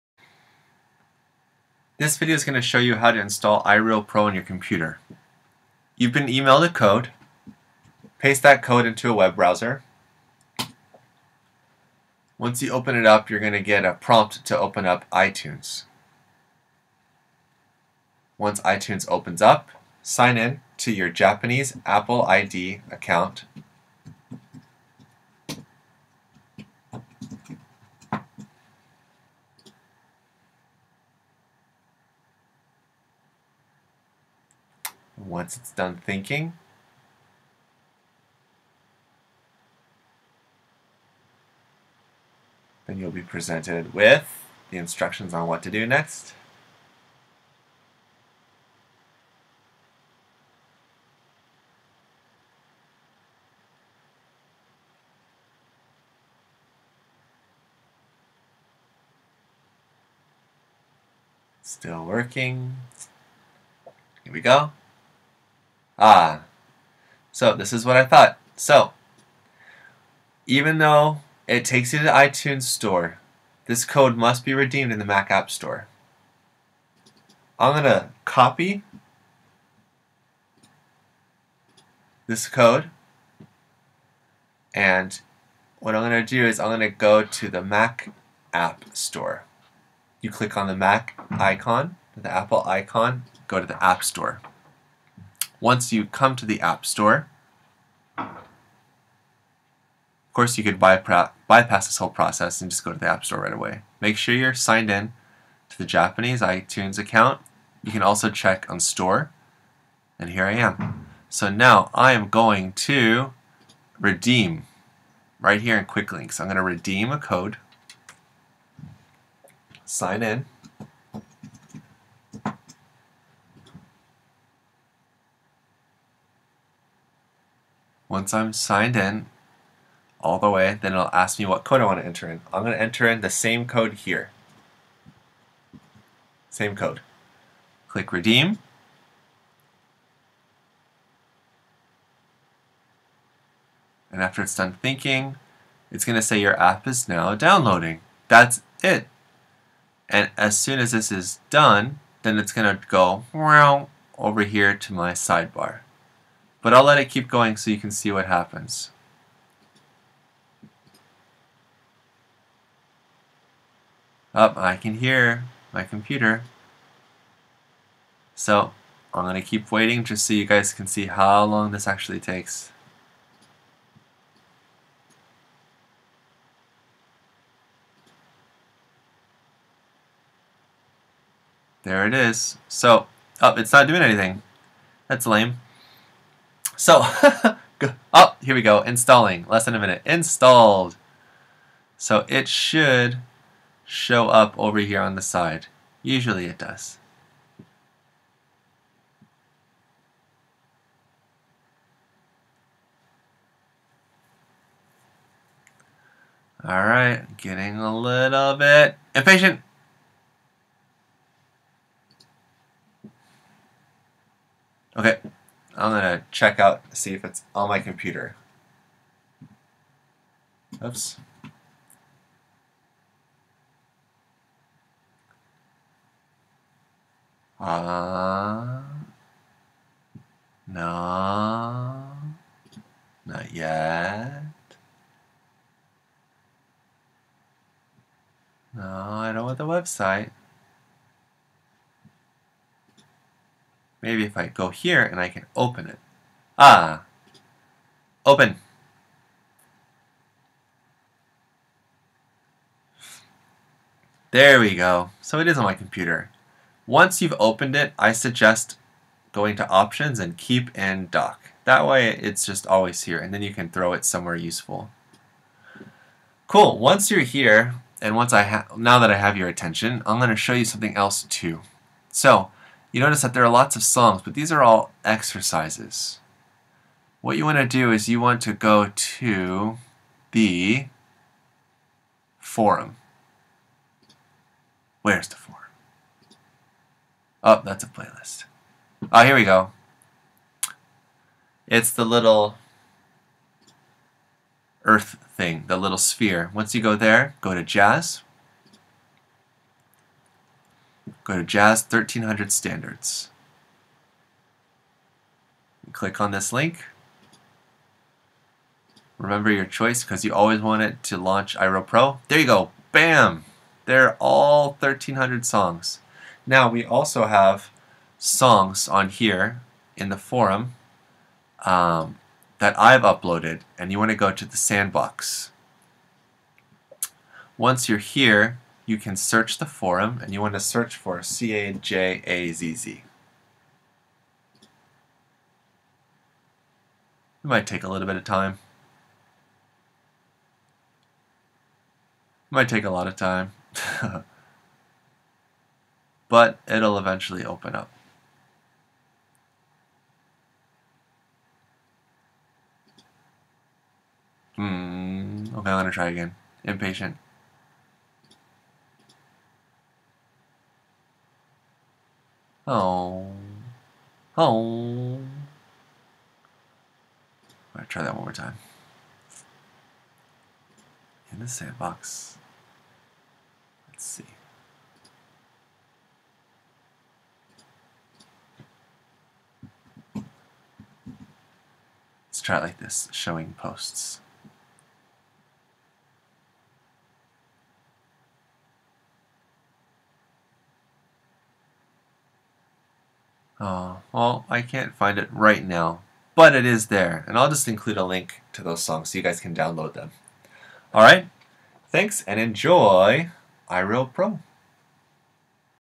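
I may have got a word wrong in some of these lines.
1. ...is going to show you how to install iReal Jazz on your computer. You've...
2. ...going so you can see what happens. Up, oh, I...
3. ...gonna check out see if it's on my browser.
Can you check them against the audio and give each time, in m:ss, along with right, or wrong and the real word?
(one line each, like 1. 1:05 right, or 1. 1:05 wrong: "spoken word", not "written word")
1. 0:02 wrong: "Pro", not "Jazz"
2. 2:37 right
3. 3:35 wrong: "computer", not "browser".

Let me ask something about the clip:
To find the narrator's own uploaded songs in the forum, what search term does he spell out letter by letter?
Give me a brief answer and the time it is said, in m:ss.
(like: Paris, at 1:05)
CAJAZZ, at 5:31.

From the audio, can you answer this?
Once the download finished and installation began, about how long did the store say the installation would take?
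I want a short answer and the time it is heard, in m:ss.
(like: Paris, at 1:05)
Less than a minute, at 3:09.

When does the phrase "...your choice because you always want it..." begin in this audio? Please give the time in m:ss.
5:09.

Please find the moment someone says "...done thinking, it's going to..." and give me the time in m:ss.
2:24.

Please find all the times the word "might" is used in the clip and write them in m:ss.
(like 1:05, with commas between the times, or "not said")
5:37, 5:42.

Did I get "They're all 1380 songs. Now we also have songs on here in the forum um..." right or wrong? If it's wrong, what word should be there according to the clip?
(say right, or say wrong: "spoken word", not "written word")
wrong: "1300", not "1380".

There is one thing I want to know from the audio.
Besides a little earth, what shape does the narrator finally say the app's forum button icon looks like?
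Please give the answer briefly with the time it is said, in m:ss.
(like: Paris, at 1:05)
Sphere, at 4:55.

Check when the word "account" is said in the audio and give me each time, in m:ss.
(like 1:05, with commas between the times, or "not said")
0:22, 1:46.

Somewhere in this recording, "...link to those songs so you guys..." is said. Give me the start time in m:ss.
6:38.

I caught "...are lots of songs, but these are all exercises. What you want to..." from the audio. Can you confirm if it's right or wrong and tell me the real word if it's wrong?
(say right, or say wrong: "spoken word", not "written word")
right.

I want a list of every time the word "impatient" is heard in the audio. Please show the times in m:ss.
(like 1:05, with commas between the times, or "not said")
3:29, 5:56.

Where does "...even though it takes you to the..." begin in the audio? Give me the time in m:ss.
1:10.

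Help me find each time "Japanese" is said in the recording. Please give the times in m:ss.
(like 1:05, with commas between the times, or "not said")
0:21, 1:45.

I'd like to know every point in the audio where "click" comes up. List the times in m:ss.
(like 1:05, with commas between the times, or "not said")
1:30, 2:17, 5:05.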